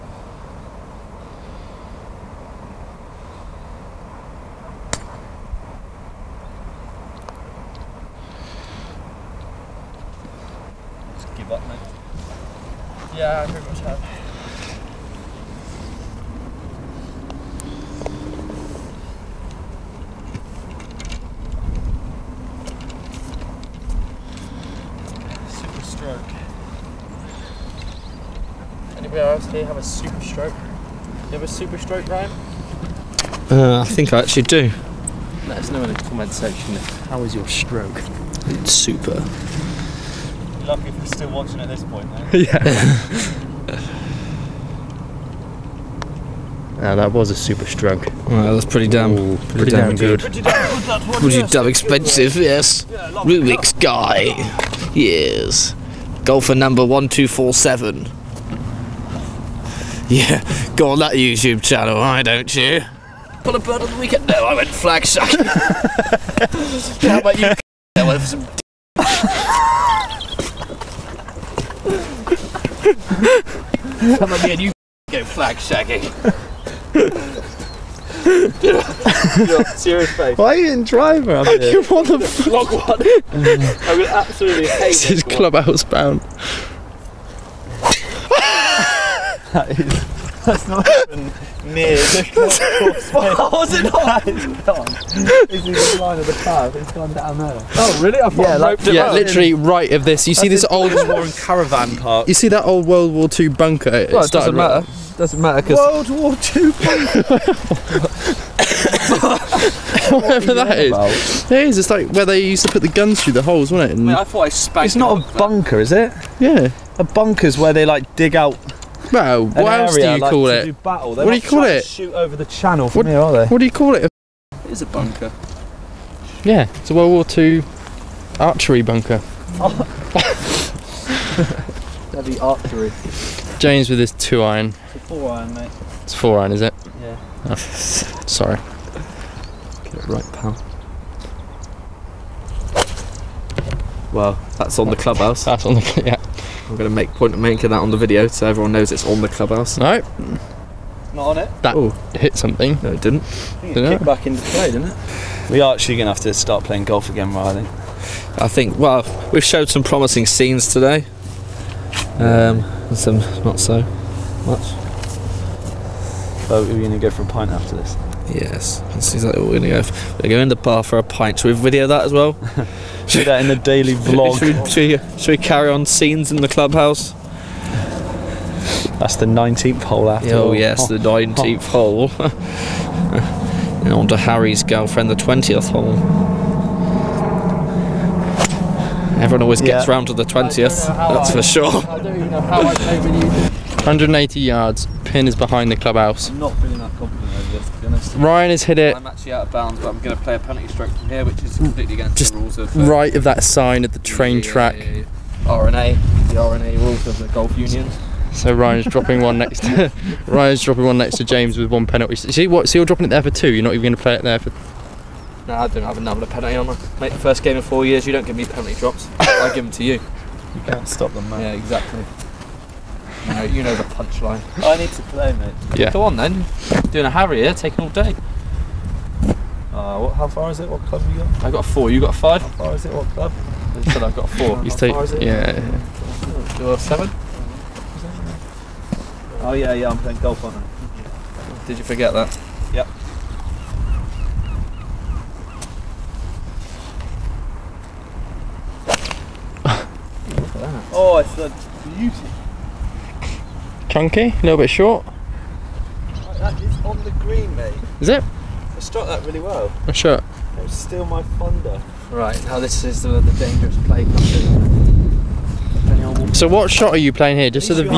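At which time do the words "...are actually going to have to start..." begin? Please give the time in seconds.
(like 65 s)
155 s.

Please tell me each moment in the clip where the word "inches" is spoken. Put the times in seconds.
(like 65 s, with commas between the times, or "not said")
not said.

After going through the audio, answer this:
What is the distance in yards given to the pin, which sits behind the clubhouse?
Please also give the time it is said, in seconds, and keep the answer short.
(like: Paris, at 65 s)
180, at 191 s.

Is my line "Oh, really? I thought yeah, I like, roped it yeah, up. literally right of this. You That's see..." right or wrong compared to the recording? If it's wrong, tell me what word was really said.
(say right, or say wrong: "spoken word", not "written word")
right.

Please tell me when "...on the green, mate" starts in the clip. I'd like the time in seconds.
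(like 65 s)
256 s.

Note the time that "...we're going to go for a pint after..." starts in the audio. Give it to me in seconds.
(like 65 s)
166 s.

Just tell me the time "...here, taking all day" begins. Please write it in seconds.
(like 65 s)
227 s.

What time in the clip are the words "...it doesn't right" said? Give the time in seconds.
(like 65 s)
104 s.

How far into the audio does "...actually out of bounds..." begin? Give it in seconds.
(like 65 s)
199 s.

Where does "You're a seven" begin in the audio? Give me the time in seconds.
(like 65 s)
236 s.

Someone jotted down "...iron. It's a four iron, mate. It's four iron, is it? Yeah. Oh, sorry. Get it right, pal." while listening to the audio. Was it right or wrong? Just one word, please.
right.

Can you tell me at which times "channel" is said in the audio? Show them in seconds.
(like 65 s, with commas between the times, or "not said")
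61 s, 122 s.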